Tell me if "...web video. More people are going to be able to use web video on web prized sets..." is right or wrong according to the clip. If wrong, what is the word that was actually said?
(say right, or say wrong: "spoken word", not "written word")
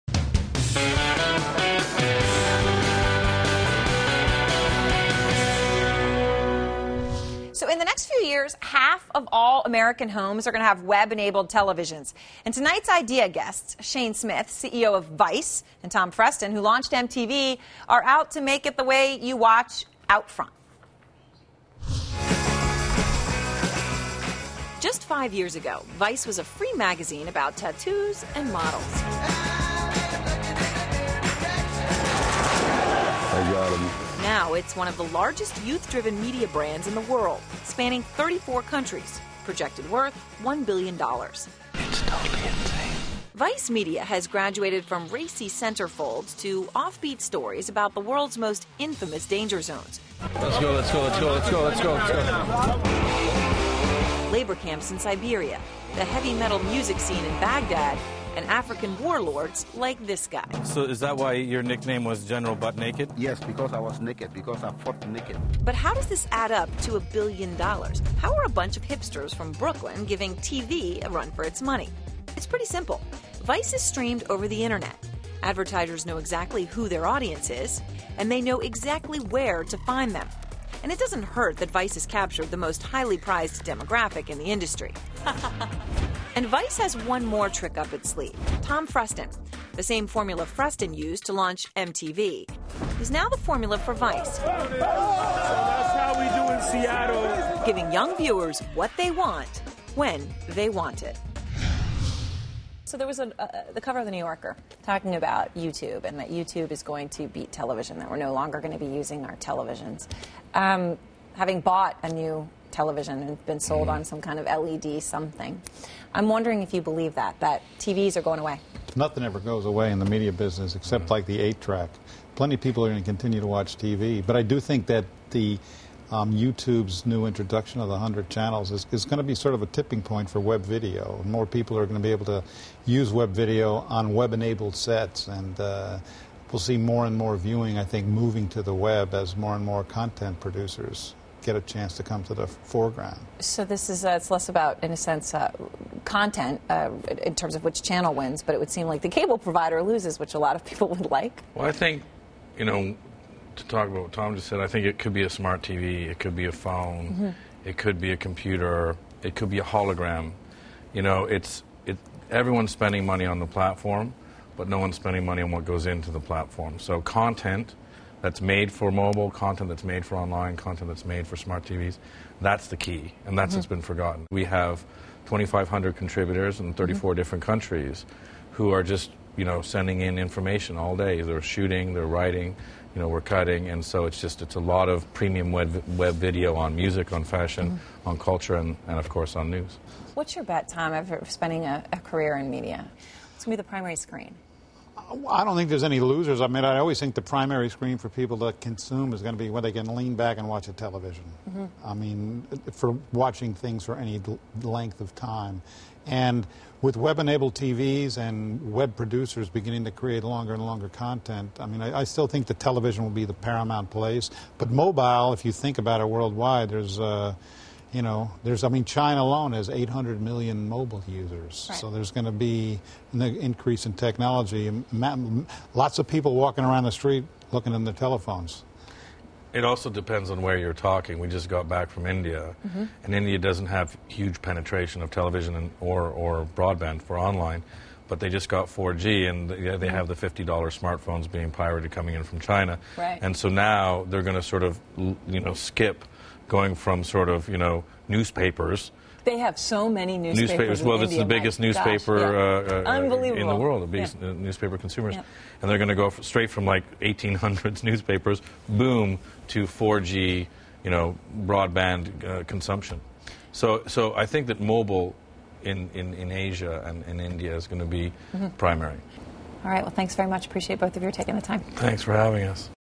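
wrong: "enabled", not "prized".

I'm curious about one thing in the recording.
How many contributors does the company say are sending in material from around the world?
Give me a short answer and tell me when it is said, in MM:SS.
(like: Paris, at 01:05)
2,500, at 02:55.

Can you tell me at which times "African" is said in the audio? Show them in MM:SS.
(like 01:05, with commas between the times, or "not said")
00:58.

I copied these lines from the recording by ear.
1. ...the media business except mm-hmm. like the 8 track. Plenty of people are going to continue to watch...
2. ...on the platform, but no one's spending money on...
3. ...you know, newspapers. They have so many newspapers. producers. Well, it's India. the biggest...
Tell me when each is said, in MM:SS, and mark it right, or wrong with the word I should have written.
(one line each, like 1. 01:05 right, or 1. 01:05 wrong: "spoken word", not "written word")
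1. 01:59 right
2. 02:43 right
3. 04:07 wrong: "newspapers", not "producers".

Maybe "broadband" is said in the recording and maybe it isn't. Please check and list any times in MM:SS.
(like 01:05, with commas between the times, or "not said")
03:56, 04:21.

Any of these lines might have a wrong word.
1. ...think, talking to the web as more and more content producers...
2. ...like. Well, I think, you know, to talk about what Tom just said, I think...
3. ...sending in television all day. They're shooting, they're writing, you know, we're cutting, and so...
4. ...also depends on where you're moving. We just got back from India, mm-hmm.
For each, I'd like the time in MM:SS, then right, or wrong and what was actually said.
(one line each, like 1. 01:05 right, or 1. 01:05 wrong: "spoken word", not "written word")
1. 02:17 wrong: "moving", not "talking"
2. 02:31 right
3. 02:59 wrong: "information", not "television"
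4. 03:49 wrong: "talking", not "moving".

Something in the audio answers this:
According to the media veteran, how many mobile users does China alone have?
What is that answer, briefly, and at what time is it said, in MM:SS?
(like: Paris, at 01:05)
800 million, at 03:39.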